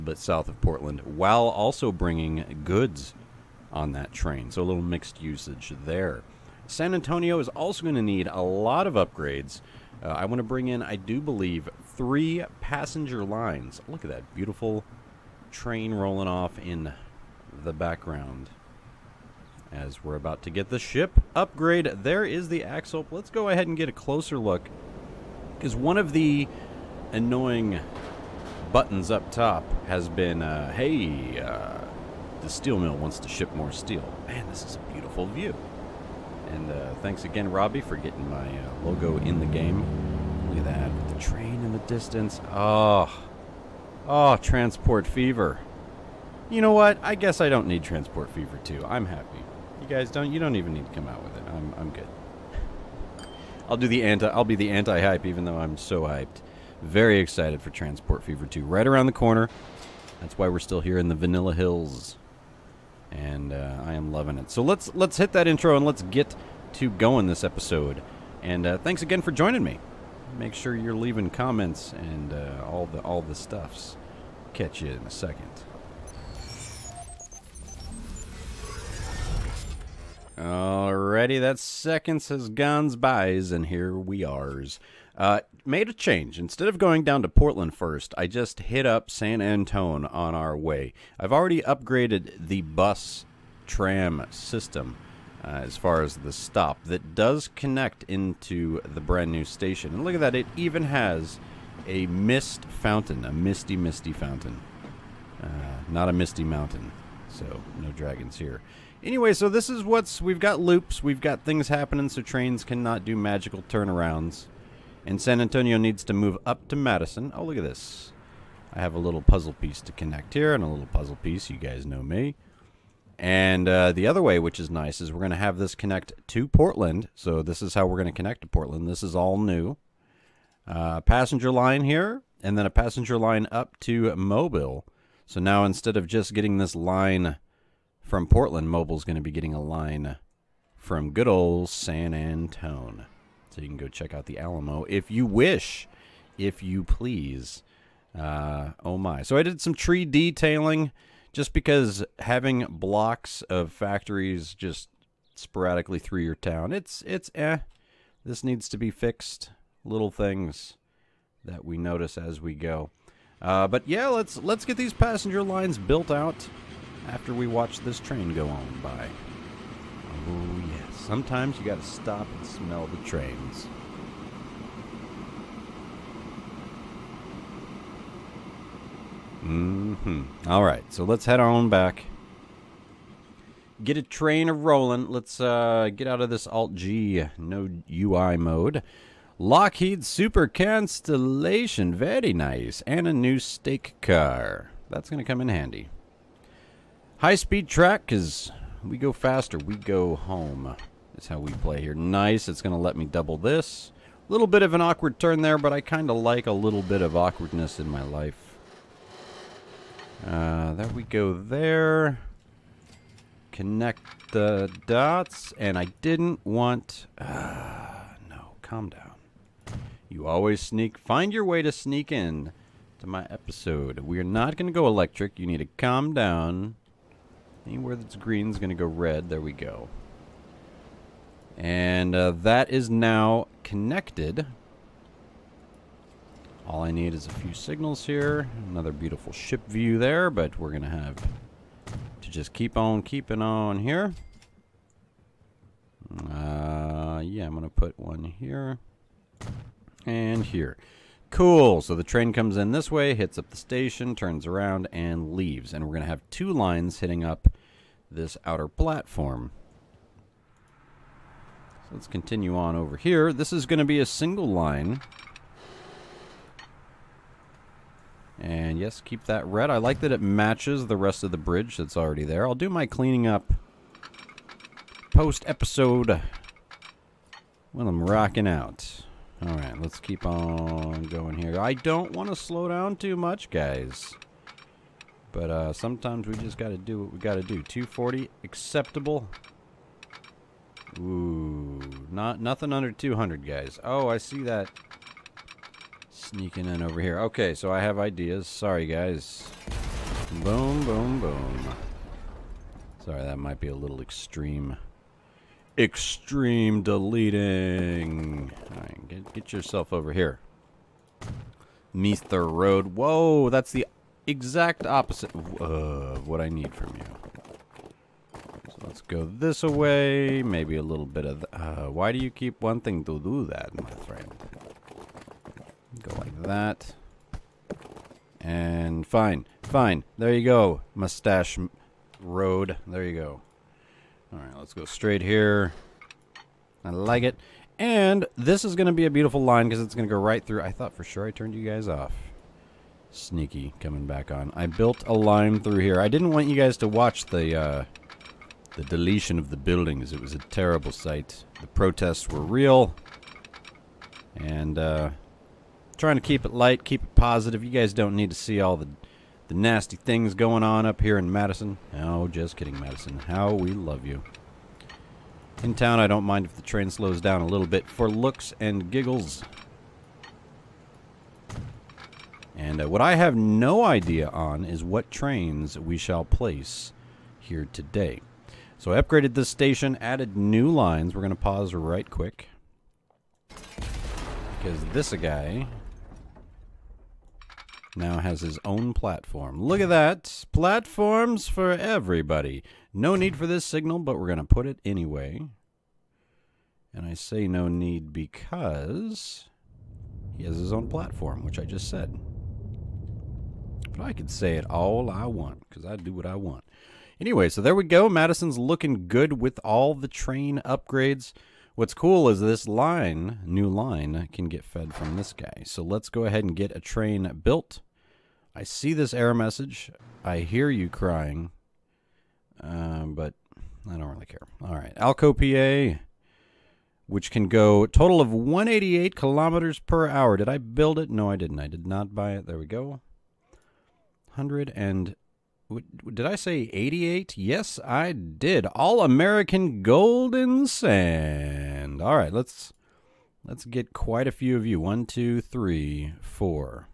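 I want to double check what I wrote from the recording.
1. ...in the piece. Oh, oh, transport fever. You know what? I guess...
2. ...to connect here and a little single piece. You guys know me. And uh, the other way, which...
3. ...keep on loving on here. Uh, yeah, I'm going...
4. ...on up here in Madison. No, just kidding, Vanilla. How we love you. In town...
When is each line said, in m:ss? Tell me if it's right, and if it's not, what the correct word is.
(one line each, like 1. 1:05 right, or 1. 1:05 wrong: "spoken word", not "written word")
1. 0:41 wrong: "distance", not "piece"
2. 1:59 wrong: "puzzle", not "single"
3. 4:02 wrong: "keeping", not "loving"
4. 6:00 wrong: "Madison", not "Vanilla".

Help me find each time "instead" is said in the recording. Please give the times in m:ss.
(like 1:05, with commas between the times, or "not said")
1:26, 2:15.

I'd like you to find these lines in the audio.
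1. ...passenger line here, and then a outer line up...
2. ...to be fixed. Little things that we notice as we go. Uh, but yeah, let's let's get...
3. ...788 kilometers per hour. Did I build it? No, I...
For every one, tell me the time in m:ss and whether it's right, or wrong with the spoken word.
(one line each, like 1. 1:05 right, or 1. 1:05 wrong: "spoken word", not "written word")
1. 2:11 wrong: "passenger", not "outer"
2. 2:38 right
3. 7:08 wrong: "188", not "788".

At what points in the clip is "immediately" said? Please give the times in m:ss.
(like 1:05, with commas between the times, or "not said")
not said.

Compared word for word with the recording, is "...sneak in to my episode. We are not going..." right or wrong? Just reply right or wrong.
right.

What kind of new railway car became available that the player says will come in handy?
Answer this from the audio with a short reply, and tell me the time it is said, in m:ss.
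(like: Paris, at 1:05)
stake car, at 3:13.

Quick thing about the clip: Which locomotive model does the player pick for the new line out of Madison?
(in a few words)
Alco PA.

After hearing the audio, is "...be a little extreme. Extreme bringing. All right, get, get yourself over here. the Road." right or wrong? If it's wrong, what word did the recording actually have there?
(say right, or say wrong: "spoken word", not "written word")
wrong: "deleting", not "bringing".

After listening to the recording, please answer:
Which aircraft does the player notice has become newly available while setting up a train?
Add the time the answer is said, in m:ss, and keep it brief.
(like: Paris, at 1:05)
Lockheed Super Constellation, at 3:09.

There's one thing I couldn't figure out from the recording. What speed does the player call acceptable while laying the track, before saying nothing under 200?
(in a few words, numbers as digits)
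240.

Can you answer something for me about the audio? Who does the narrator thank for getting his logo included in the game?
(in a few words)
Robbie.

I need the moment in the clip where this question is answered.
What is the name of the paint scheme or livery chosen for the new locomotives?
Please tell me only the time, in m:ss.
7:18.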